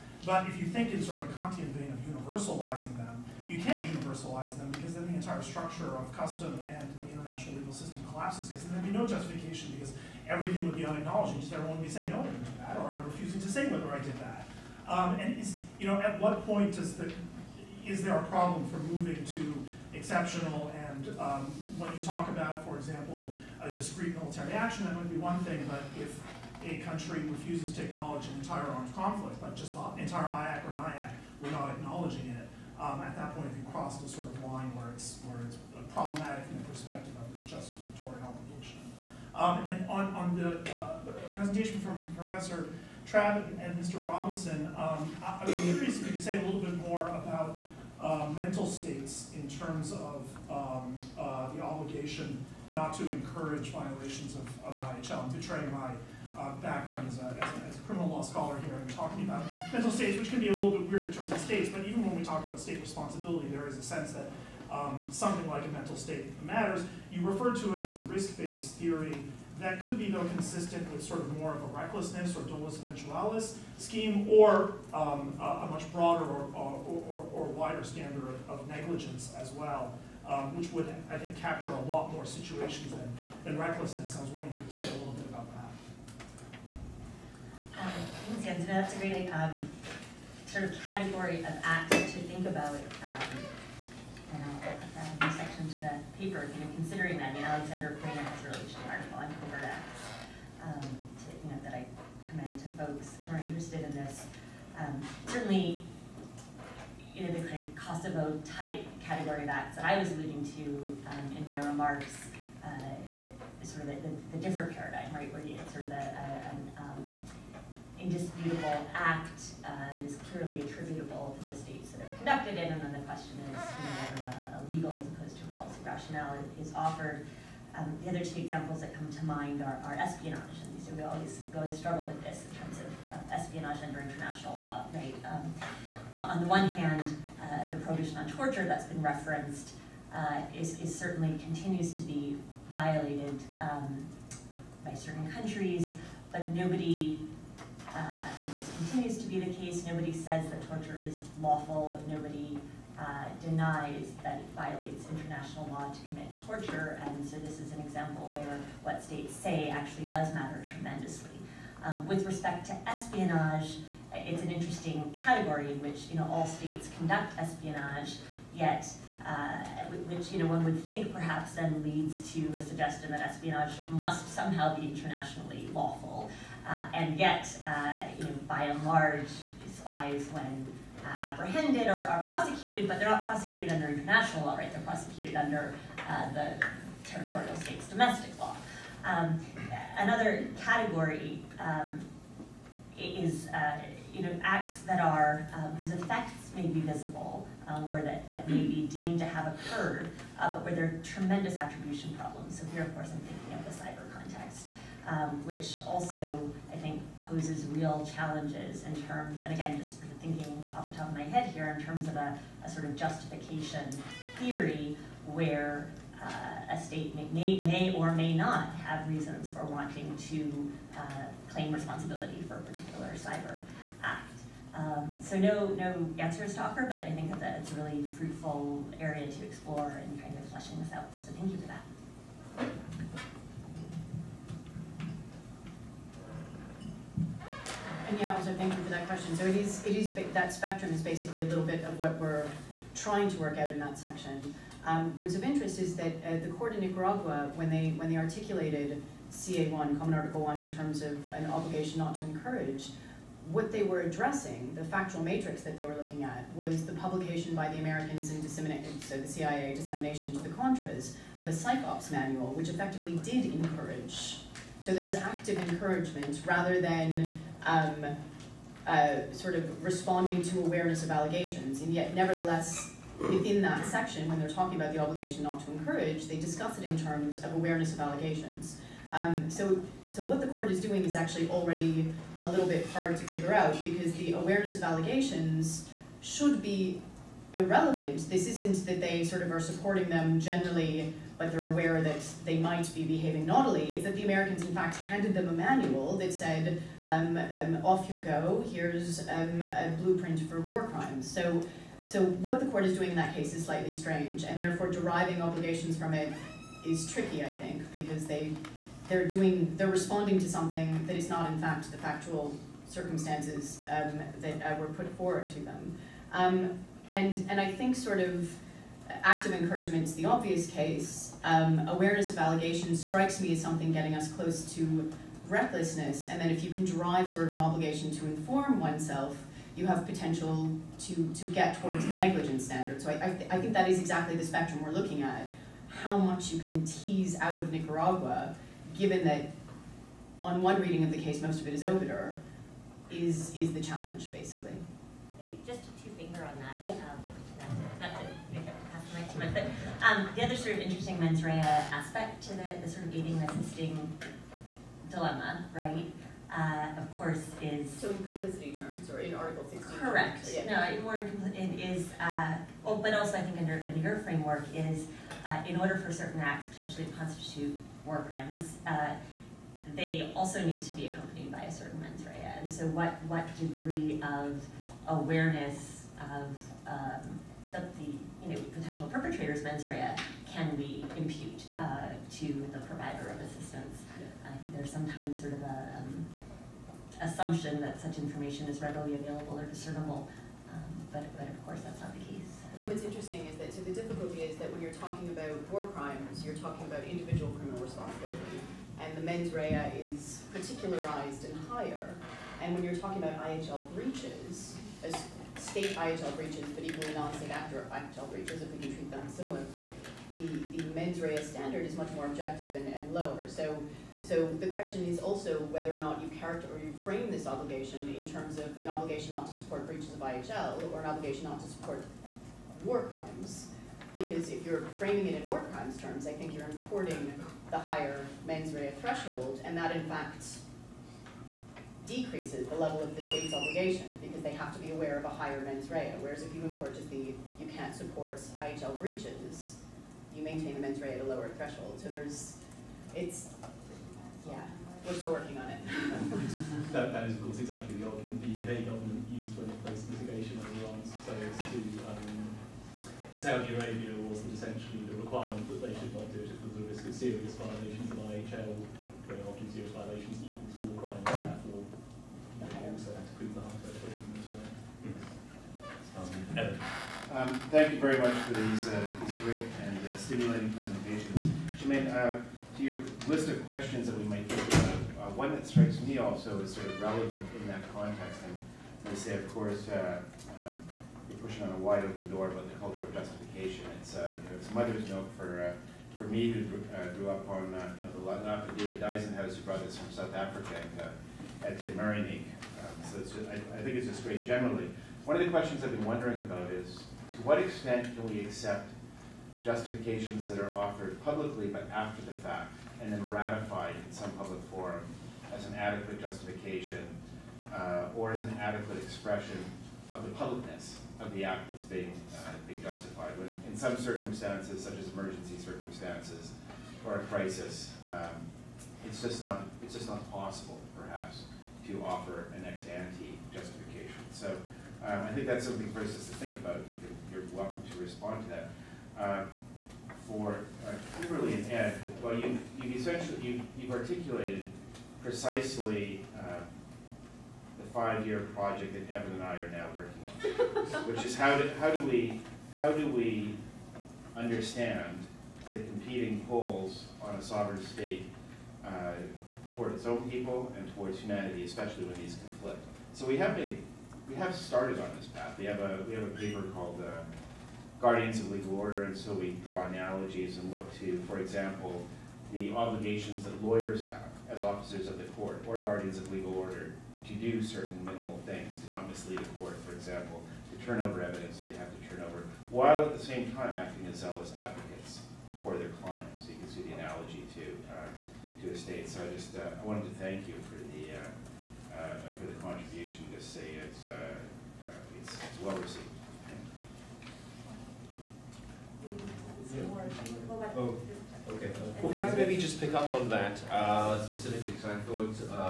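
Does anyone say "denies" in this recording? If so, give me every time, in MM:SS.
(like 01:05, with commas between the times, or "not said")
02:33.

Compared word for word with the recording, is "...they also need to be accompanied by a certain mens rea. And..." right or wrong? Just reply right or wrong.
right.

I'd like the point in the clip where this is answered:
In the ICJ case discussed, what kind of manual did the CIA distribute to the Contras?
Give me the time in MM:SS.
04:21.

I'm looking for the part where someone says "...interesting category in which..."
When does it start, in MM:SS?
02:44.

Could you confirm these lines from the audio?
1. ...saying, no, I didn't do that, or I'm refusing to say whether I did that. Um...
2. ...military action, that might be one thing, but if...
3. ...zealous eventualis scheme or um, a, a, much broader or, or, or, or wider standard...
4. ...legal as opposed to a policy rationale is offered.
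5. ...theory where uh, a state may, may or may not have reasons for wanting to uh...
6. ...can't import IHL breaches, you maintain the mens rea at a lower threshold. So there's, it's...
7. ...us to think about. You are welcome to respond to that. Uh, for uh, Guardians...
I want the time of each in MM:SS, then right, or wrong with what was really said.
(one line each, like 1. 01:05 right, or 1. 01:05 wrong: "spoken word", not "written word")
1. 00:11 right
2. 00:24 right
3. 01:12 wrong: "dolus", not "zealous"
4. 02:04 right
5. 03:34 right
6. 07:17 wrong: "support", not "import"
7. 08:46 wrong: "Kimberly", not "Guardians".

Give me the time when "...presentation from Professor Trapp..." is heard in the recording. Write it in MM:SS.
00:41.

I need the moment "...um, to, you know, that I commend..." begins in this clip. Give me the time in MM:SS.
01:40.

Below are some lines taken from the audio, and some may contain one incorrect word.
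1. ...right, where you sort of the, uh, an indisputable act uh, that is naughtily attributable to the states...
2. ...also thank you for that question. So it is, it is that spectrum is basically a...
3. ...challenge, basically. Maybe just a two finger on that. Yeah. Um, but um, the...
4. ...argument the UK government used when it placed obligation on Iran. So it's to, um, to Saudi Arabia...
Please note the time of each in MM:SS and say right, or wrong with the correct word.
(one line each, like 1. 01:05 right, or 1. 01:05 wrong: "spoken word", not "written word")
1. 01:55 wrong: "clearly", not "naughtily"
2. 03:58 right
3. 05:43 right
4. 07:28 wrong: "mitigation", not "obligation".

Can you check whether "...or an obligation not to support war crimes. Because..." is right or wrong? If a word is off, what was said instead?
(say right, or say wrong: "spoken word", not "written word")
right.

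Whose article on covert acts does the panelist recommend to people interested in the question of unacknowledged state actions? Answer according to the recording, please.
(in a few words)
Alexander Quinn.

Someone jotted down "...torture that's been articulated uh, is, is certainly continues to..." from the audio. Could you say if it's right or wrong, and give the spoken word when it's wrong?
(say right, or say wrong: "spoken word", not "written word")
wrong: "referenced", not "articulated".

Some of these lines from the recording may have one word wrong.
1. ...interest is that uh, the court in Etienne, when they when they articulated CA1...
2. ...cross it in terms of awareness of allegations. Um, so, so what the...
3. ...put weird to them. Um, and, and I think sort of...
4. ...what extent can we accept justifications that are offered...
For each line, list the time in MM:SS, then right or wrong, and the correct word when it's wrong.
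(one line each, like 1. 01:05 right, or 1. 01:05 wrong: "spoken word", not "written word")
1. 04:05 wrong: "Nicaragua", not "Etienne"
2. 04:36 wrong: "discuss", not "cross"
3. 05:14 wrong: "forward", not "weird"
4. 08:17 right.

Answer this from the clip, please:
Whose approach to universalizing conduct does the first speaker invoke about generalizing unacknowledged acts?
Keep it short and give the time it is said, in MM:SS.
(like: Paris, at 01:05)
Kantian, at 00:01.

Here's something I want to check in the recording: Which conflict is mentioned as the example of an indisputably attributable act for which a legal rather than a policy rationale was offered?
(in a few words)
Kosovo.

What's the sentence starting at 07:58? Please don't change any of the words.
And they say, of course, uh, um, you're pushing on a wide open door about the culture of justification.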